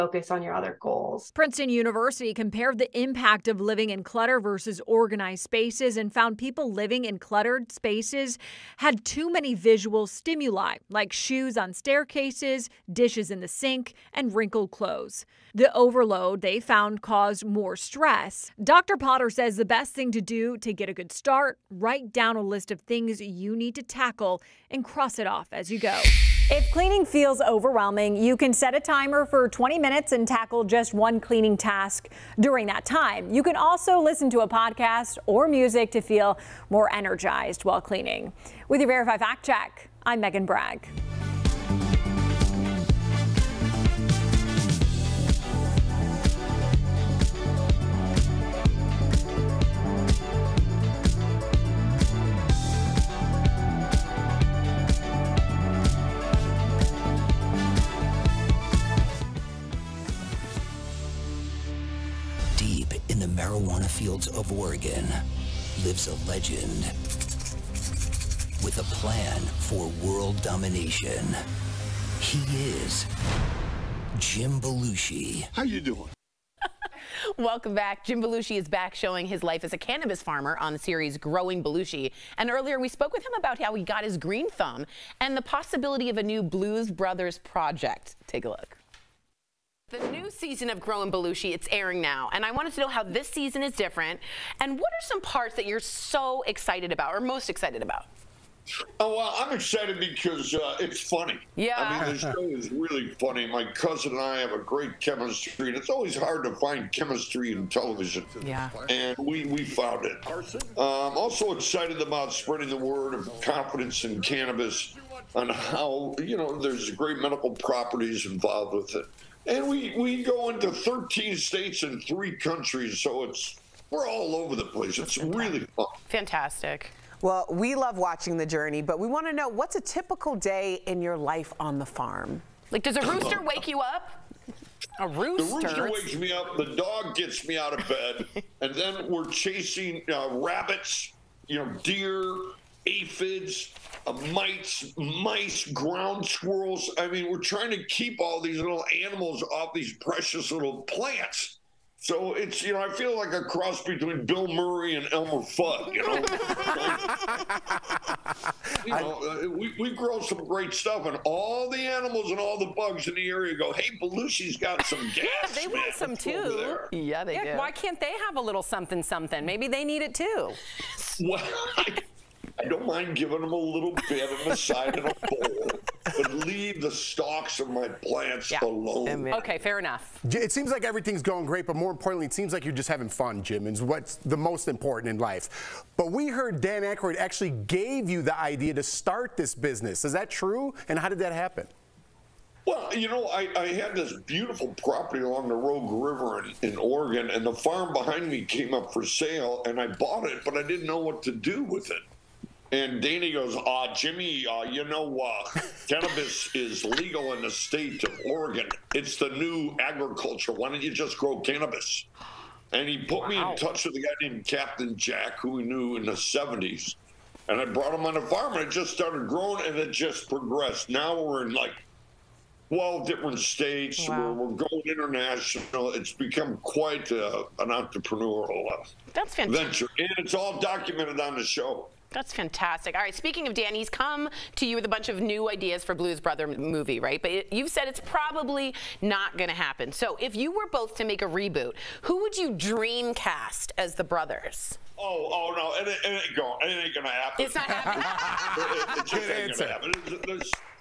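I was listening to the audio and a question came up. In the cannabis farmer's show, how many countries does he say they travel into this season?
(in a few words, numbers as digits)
3.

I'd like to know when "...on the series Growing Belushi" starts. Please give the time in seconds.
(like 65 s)
80 s.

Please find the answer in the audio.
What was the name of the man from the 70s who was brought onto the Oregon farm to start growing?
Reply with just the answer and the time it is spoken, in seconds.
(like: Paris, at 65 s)
Captain Jack, at 214 s.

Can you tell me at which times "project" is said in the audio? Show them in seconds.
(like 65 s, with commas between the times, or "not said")
87 s.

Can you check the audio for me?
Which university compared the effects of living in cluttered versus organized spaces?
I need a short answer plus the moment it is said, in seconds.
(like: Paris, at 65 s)
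Princeton University, at 1 s.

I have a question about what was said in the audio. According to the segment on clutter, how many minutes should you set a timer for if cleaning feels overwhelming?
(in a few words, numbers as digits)
20.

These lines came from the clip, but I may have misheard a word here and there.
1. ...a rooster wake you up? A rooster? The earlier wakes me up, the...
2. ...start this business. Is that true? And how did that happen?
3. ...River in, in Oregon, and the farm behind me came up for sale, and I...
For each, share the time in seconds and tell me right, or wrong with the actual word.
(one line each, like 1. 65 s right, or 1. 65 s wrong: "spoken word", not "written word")
1. 132 s wrong: "rooster", not "earlier"
2. 188 s right
3. 195 s right.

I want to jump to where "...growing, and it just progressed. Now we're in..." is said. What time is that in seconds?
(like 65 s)
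219 s.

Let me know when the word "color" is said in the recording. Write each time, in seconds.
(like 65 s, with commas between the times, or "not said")
not said.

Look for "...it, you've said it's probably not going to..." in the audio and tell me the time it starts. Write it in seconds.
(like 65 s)
237 s.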